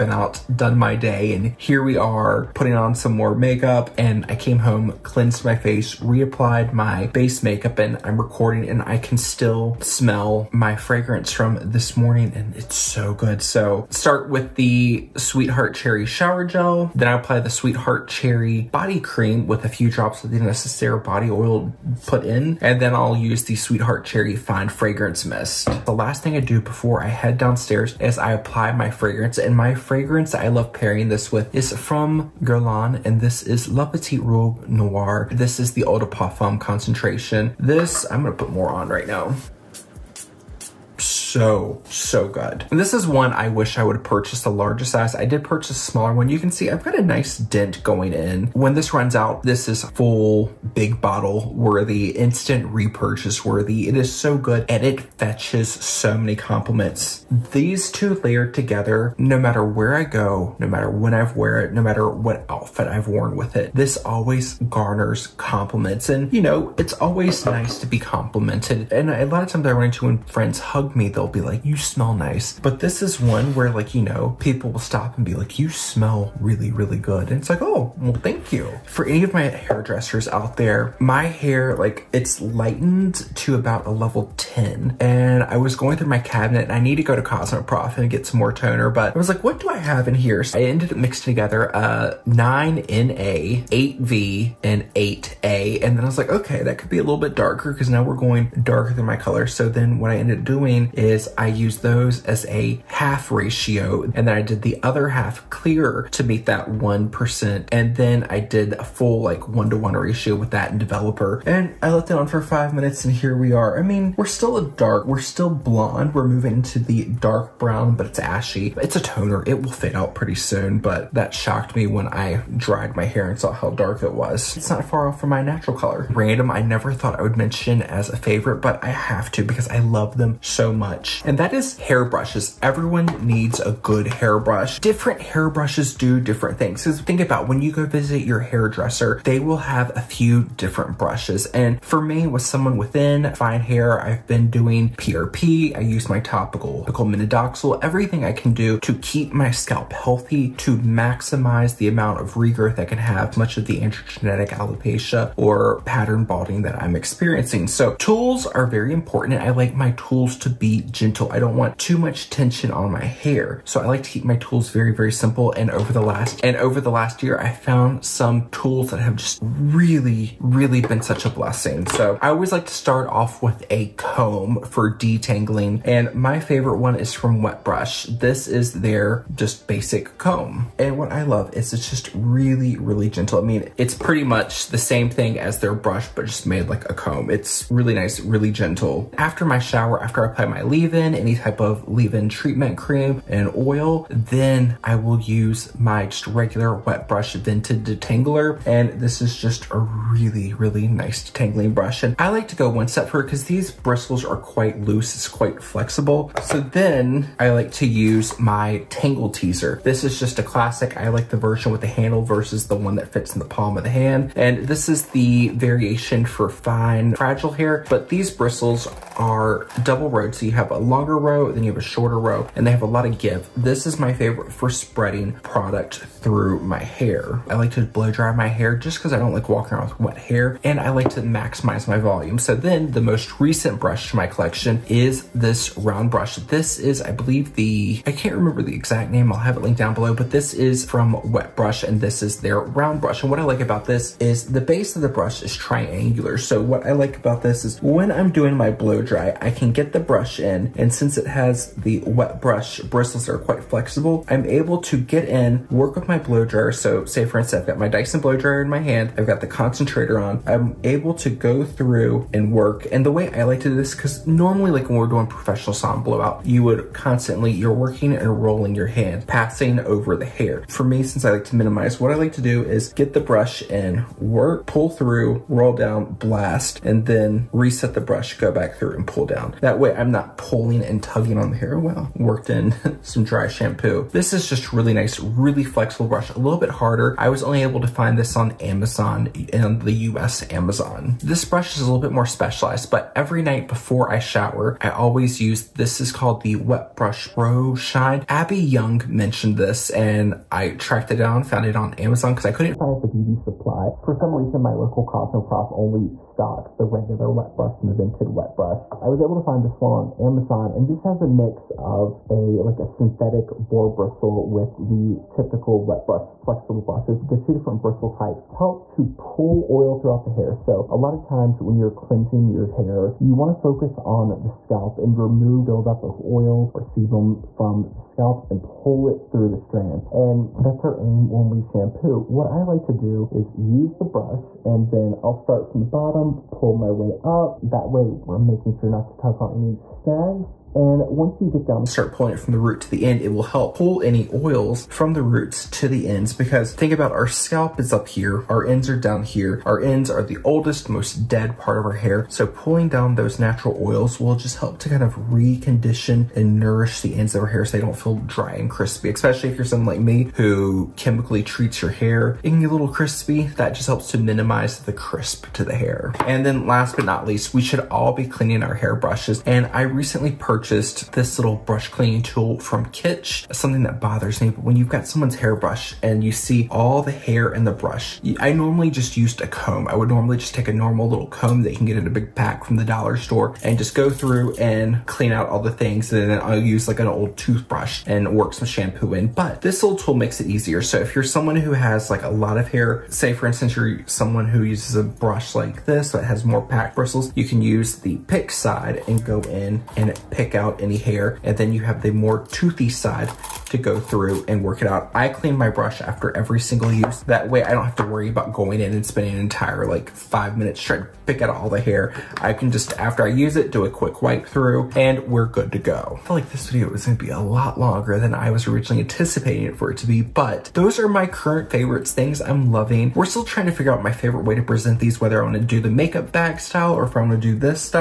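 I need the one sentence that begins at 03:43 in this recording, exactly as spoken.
This is my favorite for spreading product through my hair.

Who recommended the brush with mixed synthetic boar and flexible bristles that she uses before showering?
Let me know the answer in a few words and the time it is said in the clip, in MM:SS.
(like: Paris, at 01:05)
Abby Young, at 04:58.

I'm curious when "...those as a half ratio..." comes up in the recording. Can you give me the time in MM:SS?
01:41.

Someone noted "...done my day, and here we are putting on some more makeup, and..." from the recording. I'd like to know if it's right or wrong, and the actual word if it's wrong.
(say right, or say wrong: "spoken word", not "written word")
right.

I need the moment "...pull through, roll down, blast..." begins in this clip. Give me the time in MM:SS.
04:34.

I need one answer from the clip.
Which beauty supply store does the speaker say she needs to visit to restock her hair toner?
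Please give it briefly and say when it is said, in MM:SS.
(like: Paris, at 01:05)
Cosmoprof, at 01:27.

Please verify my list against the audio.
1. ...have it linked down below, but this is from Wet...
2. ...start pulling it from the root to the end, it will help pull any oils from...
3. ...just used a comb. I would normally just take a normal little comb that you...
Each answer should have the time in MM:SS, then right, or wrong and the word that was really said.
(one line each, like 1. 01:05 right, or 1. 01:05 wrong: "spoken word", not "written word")
1. 03:59 right
2. 05:41 right
3. 06:18 right.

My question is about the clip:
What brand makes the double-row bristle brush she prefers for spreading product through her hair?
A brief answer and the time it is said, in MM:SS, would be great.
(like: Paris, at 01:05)
Tangle Teezer, at 03:28.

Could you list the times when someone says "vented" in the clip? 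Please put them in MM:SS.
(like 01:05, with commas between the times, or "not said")
03:17, 05:07.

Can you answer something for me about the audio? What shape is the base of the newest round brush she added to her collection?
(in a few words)
Triangular.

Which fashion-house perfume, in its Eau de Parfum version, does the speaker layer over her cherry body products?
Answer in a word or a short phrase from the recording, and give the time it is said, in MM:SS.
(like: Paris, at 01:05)
La Petite Robe Noire, at 00:33.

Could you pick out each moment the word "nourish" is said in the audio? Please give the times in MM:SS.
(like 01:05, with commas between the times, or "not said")
05:56.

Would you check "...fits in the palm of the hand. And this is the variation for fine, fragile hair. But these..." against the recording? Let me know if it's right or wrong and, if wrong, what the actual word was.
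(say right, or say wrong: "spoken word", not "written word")
right.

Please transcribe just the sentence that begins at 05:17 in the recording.
The two different bristle types help to pull oil throughout the hair.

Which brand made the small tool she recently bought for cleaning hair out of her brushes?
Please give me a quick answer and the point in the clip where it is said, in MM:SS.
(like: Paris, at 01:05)
Kitsch, at 06:12.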